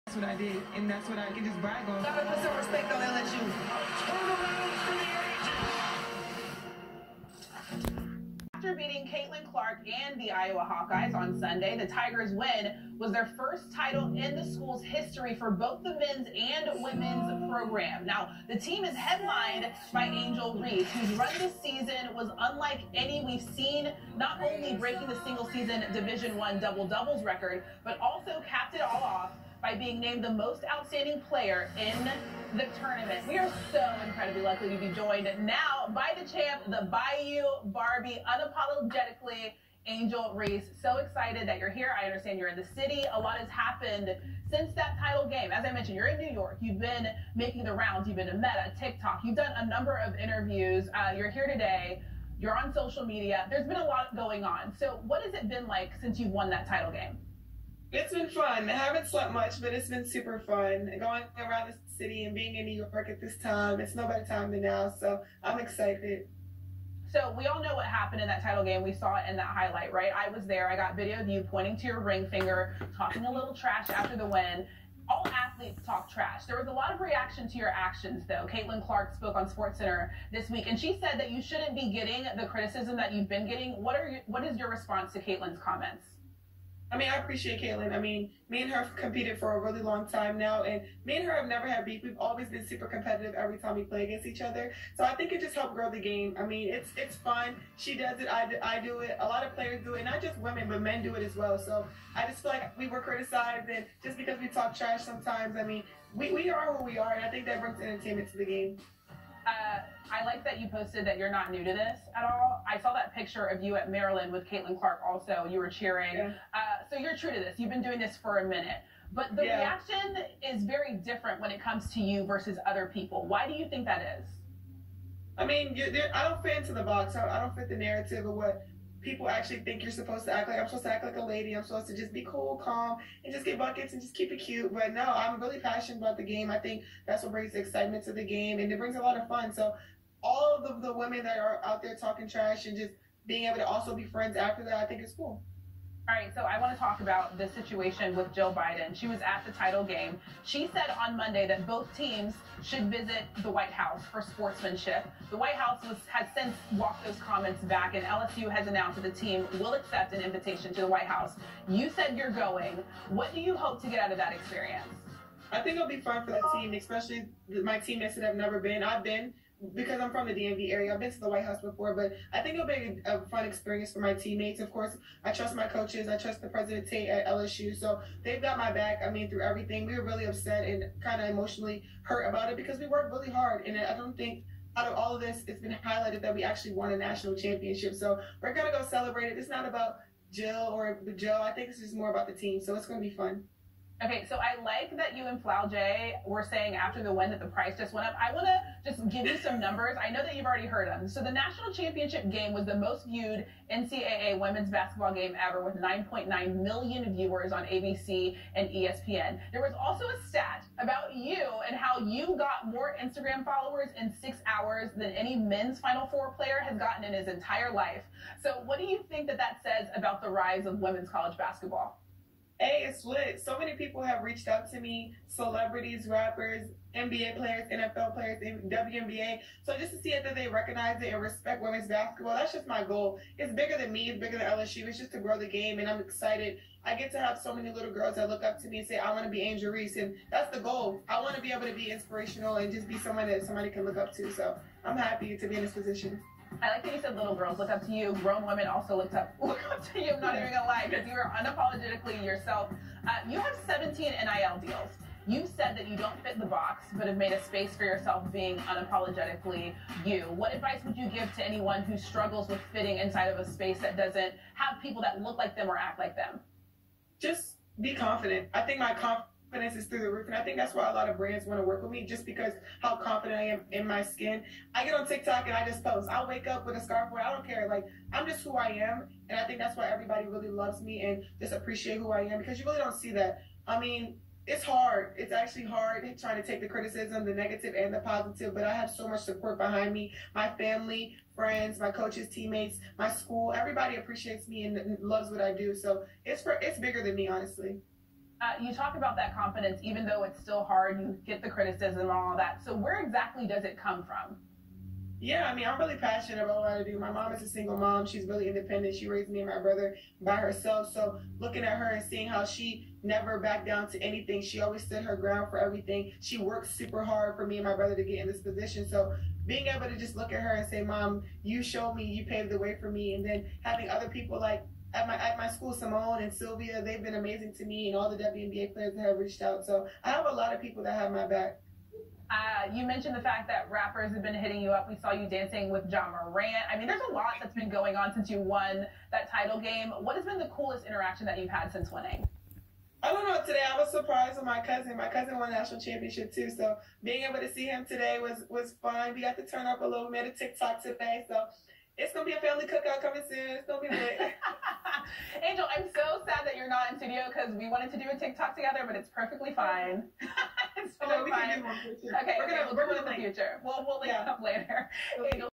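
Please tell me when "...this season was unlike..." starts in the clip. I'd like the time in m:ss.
0:21.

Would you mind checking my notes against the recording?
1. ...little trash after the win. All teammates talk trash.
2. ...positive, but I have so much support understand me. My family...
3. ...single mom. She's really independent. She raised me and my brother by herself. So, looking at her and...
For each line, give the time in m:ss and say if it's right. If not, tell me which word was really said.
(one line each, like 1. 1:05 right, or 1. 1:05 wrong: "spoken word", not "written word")
1. 1:13 wrong: "athletes", not "teammates"
2. 4:47 wrong: "behind", not "understand"
3. 5:07 right.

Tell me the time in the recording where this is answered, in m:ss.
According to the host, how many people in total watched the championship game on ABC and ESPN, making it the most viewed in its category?
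3:25.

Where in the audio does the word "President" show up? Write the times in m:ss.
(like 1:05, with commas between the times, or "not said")
2:56.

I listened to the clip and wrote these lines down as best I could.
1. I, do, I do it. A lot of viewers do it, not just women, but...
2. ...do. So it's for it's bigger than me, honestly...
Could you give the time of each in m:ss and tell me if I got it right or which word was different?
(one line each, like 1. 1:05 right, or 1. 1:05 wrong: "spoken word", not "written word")
1. 1:38 wrong: "players", not "viewers"
2. 4:55 right.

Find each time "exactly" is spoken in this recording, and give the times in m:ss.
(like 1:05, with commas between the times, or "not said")
5:03.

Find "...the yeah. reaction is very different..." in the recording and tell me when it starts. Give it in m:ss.
1:59.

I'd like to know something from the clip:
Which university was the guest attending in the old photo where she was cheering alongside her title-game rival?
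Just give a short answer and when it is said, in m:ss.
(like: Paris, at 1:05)
Maryland, at 1:53.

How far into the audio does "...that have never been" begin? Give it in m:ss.
2:48.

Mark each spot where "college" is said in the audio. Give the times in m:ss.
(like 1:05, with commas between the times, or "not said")
3:41.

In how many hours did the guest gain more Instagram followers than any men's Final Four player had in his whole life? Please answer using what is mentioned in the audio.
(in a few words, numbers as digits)
6.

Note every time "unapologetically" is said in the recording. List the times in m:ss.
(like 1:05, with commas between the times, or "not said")
0:38, 4:11, 4:18.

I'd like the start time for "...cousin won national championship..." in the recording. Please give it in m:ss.
5:45.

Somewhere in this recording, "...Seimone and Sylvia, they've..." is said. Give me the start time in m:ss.
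5:25.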